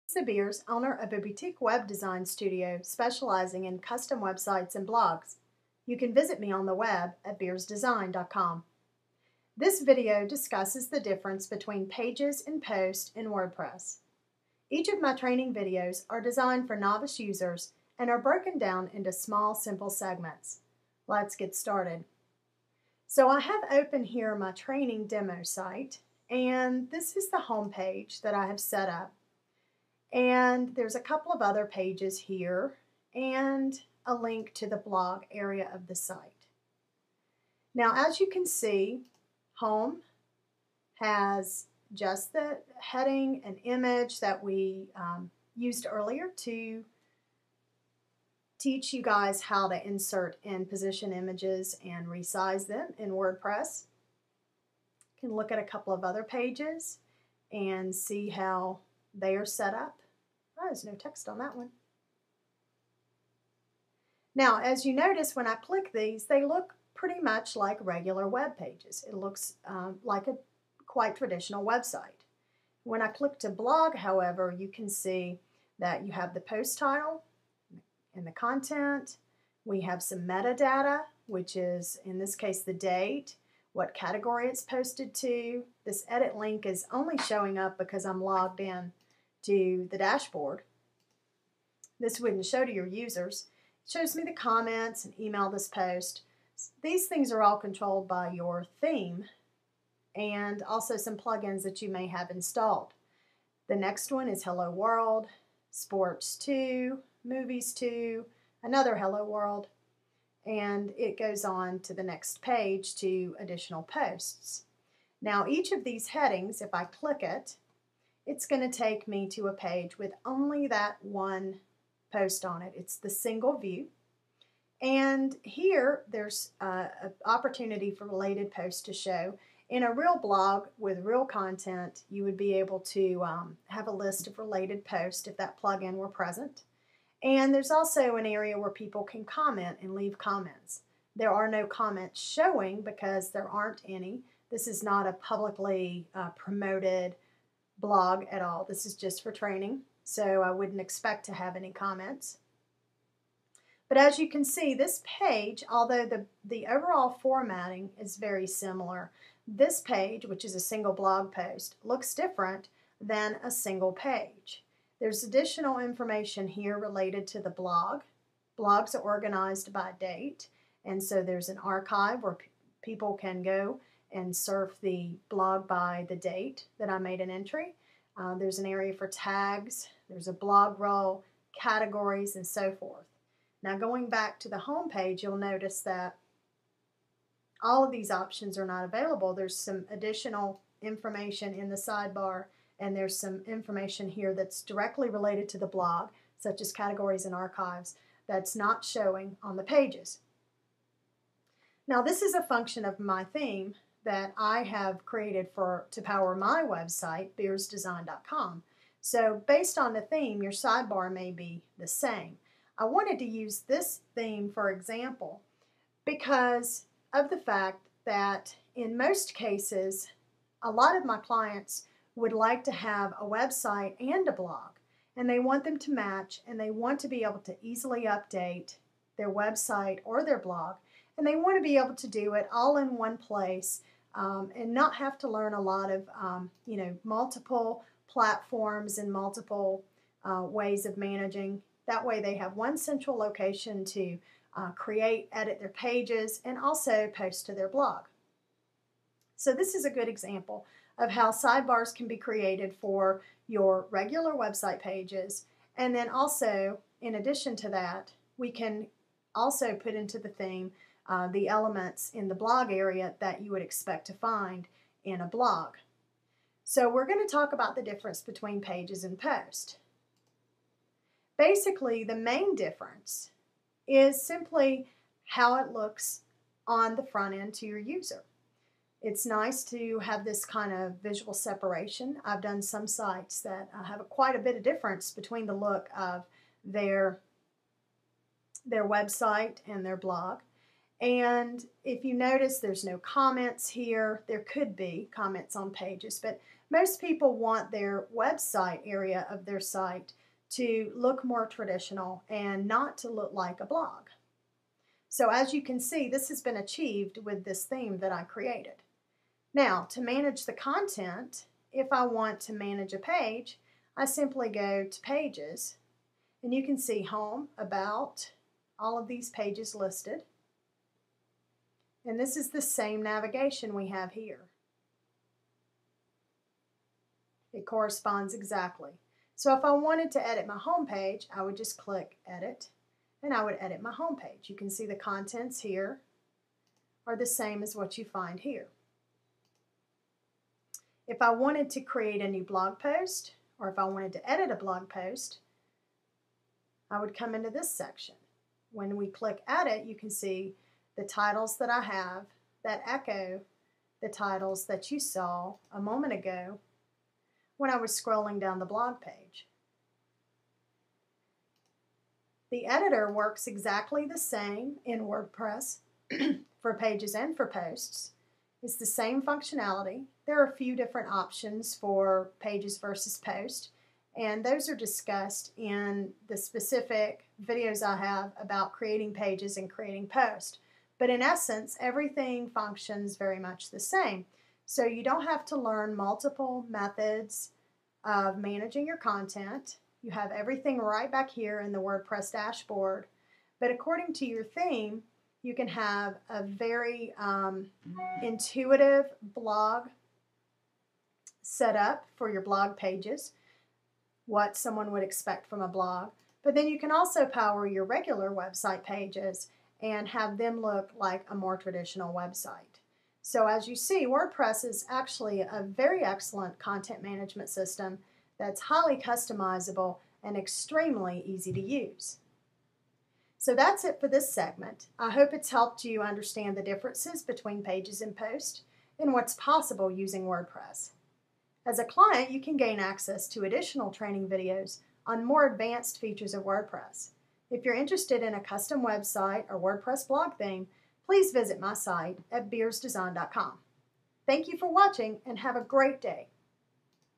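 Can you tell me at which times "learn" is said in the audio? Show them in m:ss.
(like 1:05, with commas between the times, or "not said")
3:55, 6:25.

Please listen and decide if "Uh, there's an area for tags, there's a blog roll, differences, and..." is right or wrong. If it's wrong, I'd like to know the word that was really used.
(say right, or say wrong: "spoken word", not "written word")
wrong: "categories", not "differences".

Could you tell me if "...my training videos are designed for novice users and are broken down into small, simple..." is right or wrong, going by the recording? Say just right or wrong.
right.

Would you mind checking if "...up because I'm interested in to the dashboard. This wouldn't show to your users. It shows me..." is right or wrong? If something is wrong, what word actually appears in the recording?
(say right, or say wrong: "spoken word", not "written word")
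wrong: "logged", not "interested".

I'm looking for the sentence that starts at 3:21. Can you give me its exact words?
Now this is a function of my theme that I have created for to power my website, beersdesign.com.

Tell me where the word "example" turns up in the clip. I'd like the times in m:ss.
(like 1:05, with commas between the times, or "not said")
3:34, 4:10.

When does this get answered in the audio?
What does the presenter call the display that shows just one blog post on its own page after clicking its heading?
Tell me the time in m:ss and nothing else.
2:03.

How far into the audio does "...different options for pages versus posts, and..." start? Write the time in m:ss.
6:10.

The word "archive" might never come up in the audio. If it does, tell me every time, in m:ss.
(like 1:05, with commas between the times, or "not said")
2:51, 3:17.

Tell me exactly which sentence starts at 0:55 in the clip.
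You can look at a couple of other pages and see how they are set up.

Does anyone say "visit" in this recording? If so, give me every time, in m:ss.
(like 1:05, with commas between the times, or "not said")
0:06, 7:21.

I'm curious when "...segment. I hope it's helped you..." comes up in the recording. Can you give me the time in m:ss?
7:04.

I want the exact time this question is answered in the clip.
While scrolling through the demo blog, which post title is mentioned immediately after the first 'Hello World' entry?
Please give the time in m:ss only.
1:45.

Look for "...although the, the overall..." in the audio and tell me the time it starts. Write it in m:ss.
2:35.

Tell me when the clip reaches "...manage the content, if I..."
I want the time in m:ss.
5:10.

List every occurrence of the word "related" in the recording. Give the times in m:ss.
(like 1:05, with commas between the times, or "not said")
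2:08, 2:14, 2:46, 3:15.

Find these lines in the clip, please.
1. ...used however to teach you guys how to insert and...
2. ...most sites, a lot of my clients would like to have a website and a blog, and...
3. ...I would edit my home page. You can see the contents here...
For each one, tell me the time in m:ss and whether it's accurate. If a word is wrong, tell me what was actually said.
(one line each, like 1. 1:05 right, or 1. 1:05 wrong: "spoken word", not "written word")
1. 0:45 wrong: "earlier", not "however"
2. 3:38 wrong: "cases", not "sites"
3. 5:33 right.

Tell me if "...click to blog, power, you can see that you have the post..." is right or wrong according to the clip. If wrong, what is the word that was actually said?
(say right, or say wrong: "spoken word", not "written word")
wrong: "however", not "power".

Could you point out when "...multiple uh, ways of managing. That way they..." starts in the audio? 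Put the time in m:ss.
3:59.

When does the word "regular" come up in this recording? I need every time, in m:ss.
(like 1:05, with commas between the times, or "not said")
1:07, 4:13, 6:47.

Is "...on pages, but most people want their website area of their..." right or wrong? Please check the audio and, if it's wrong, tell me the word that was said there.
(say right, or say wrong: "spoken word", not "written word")
right.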